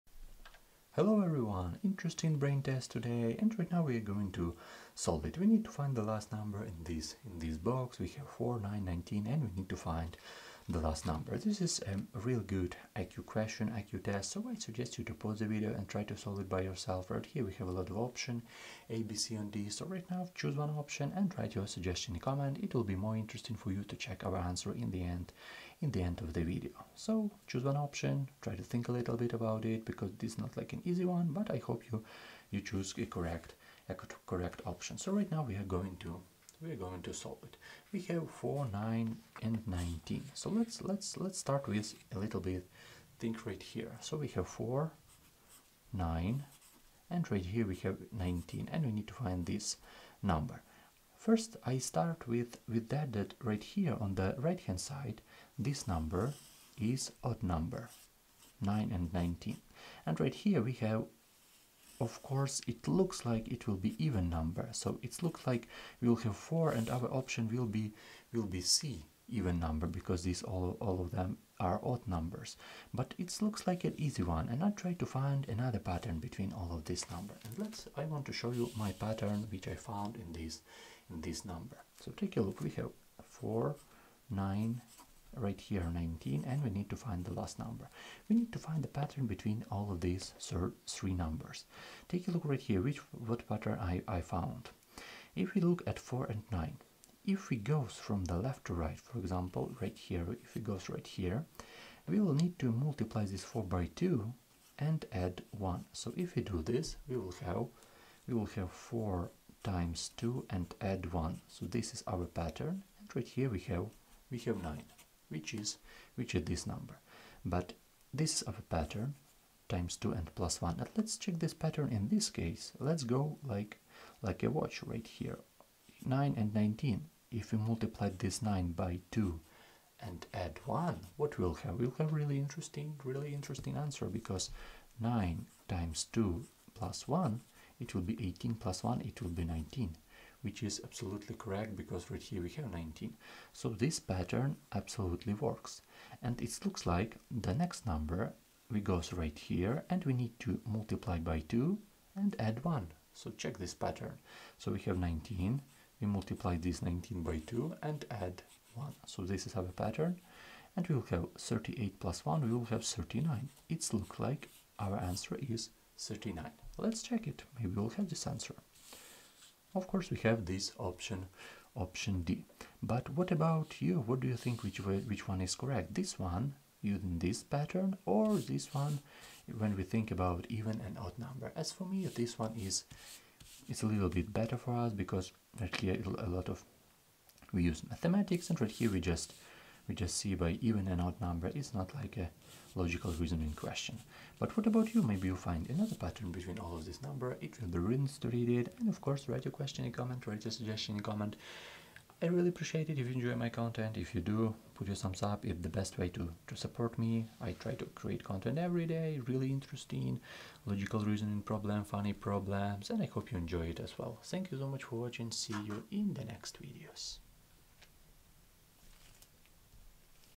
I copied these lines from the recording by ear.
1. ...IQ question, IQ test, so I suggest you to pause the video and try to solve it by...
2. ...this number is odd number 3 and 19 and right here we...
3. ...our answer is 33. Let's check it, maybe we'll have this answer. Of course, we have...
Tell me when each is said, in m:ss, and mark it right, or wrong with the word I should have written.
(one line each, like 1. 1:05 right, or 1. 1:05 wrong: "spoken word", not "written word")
1. 0:12 right
2. 0:55 wrong: "9", not "3"
3. 2:44 wrong: "39", not "33".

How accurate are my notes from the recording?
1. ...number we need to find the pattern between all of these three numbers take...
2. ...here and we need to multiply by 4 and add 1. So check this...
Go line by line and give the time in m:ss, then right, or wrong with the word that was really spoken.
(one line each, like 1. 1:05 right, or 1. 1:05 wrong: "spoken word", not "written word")
1. 1:27 right
2. 2:29 wrong: "2", not "4".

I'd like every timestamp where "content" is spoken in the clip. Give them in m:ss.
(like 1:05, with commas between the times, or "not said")
3:23, 3:28.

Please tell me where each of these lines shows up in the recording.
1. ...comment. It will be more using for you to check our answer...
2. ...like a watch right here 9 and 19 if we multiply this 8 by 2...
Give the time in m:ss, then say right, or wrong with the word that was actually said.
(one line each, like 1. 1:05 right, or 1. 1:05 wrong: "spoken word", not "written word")
1. 0:22 wrong: "interesting", not "using"
2. 2:04 wrong: "9", not "8".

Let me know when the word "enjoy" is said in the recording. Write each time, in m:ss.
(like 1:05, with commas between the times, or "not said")
3:23, 3:33.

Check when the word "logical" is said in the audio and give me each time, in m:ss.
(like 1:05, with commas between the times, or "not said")
3:12, 3:30.